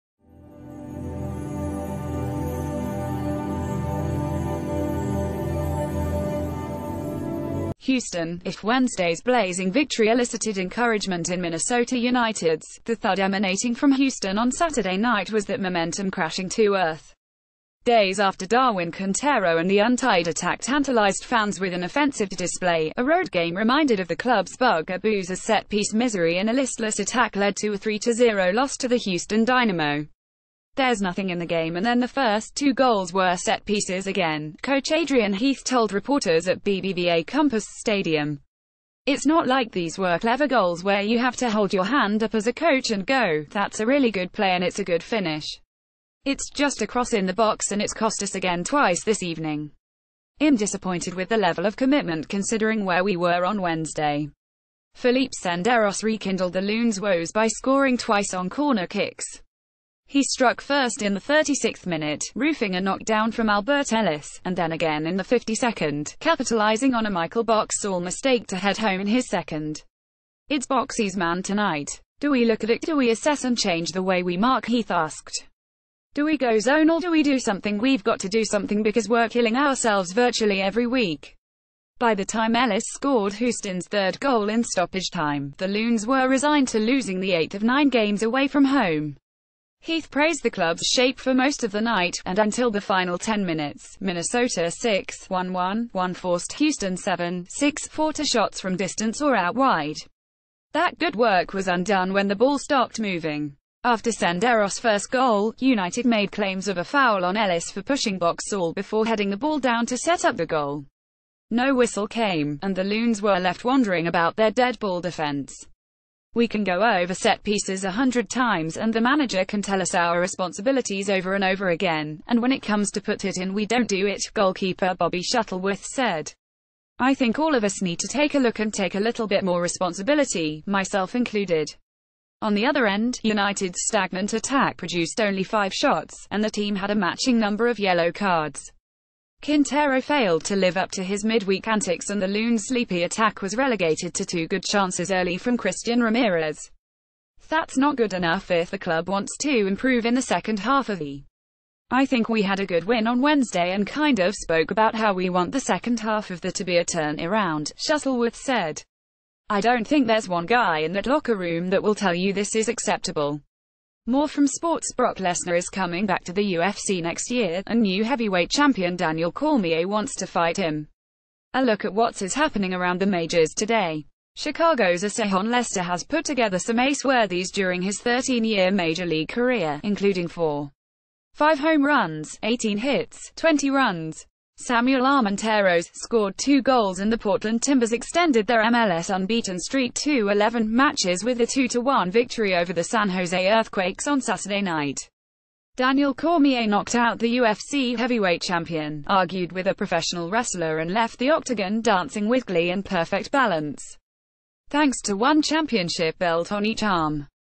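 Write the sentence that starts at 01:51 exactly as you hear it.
No whistle came, and the Loons were left wondering about their dead ball defense.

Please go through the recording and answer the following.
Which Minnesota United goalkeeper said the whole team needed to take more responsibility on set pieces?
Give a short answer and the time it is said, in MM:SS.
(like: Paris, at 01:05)
Bobby Shuttleworth, at 02:04.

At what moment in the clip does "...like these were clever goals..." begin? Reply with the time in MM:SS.
00:39.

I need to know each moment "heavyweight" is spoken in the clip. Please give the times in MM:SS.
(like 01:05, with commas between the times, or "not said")
02:48, 03:17.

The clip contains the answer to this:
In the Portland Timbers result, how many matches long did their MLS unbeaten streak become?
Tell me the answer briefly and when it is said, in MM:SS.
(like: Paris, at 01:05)
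11, at 03:10.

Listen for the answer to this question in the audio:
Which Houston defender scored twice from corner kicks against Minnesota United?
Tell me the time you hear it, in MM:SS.
00:54.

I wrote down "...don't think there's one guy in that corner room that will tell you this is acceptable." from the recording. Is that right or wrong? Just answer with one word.
wrong.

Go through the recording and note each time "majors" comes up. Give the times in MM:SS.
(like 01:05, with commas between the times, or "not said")
02:53, 02:58.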